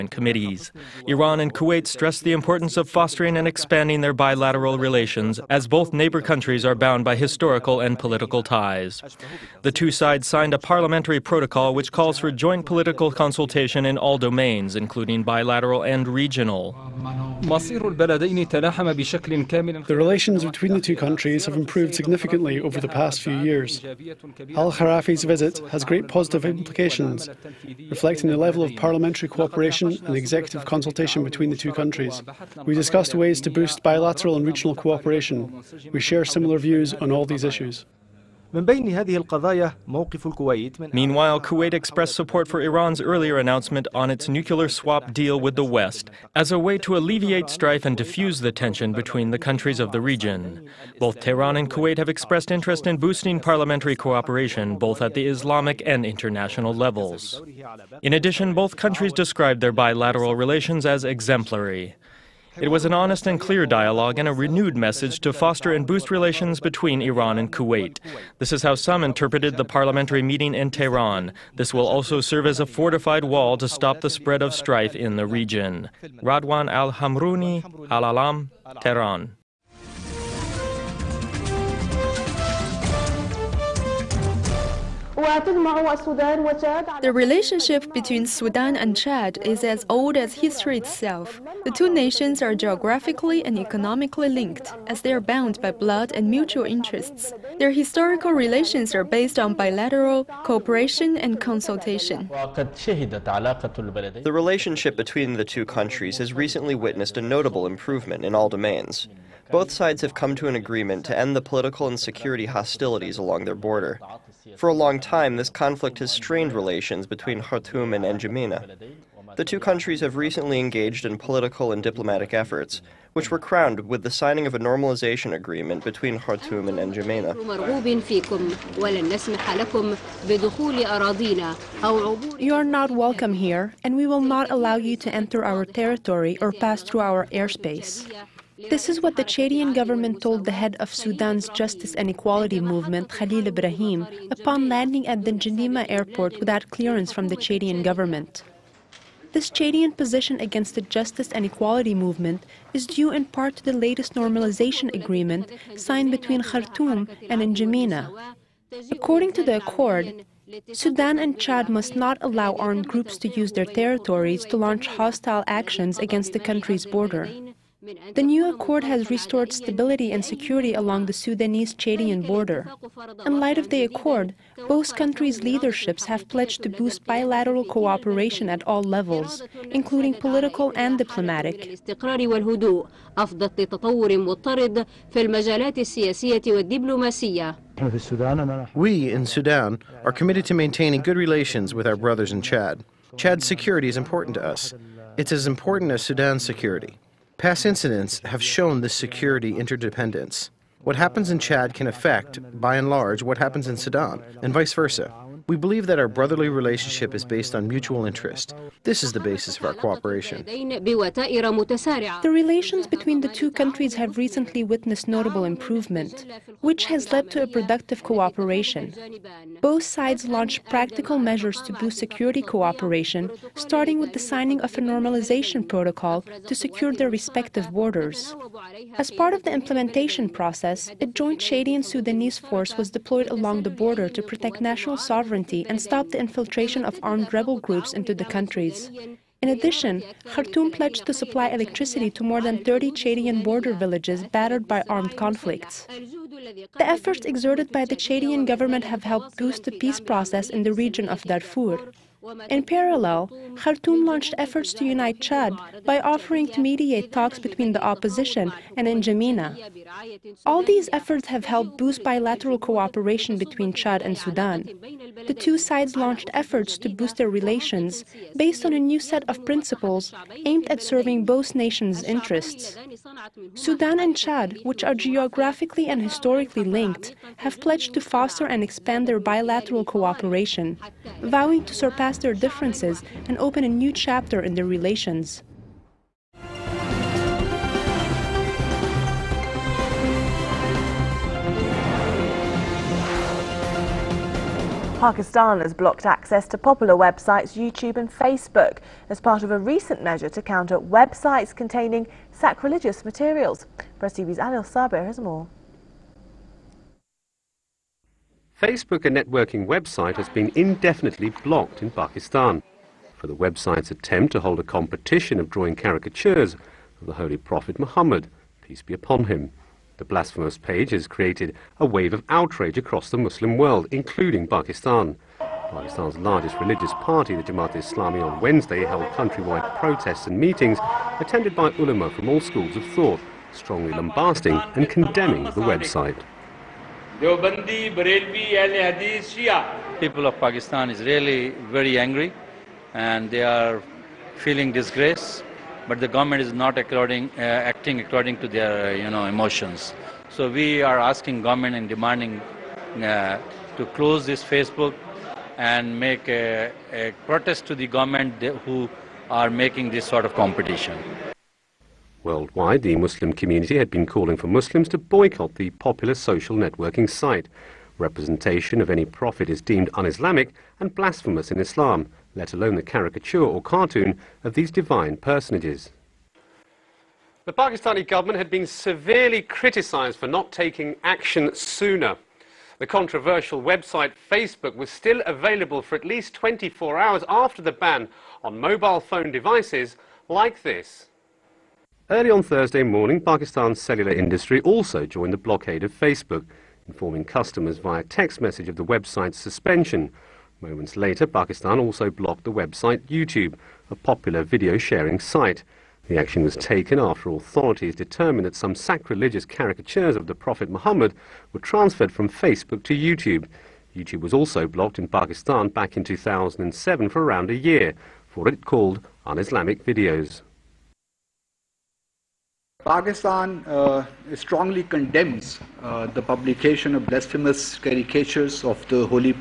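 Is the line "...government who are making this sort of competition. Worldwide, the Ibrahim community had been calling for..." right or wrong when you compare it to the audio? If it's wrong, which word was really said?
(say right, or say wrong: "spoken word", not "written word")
wrong: "Muslim", not "Ibrahim".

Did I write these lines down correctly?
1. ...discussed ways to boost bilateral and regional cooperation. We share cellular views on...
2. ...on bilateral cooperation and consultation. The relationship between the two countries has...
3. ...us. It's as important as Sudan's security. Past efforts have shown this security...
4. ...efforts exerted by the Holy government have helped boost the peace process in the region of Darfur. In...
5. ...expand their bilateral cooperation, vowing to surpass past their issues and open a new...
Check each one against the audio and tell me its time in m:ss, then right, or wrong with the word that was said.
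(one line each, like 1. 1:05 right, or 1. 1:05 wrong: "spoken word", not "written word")
1. 0:32 wrong: "similar", not "cellular"
2. 1:39 right
3. 3:14 wrong: "incidents", not "efforts"
4. 4:06 wrong: "Chadian", not "Holy"
5. 4:38 wrong: "differences", not "issues".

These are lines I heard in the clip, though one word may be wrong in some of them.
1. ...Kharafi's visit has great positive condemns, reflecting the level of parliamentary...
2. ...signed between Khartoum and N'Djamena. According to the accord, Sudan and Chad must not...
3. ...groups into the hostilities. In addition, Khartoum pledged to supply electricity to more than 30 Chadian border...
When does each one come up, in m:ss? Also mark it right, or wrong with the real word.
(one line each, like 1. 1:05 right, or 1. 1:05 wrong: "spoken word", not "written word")
1. 0:24 wrong: "implications", not "condemns"
2. 2:35 right
3. 3:57 wrong: "countries", not "hostilities".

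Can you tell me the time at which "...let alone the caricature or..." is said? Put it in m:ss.
6:12.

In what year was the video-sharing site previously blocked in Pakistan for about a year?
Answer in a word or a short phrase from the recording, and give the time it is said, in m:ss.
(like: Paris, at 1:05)
2007, at 6:56.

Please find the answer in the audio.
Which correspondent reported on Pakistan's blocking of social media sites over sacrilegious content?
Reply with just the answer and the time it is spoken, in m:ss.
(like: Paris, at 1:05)
Anil Sabir, at 5:04.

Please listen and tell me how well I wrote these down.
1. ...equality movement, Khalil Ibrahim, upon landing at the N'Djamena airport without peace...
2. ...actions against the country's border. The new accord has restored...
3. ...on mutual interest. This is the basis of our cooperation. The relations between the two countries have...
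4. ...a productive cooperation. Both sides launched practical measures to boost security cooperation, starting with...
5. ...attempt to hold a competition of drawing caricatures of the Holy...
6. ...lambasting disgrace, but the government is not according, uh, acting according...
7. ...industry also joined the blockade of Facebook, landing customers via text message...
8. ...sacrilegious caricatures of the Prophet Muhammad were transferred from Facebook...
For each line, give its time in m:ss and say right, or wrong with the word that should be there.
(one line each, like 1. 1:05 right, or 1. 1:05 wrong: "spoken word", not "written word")
1. 2:22 wrong: "clearance", not "peace"
2. 2:45 right
3. 3:27 right
4. 3:37 right
5. 5:13 right
6. 5:44 wrong: "feeling", not "lambasting"
7. 6:34 wrong: "informing", not "landing"
8. 6:48 right.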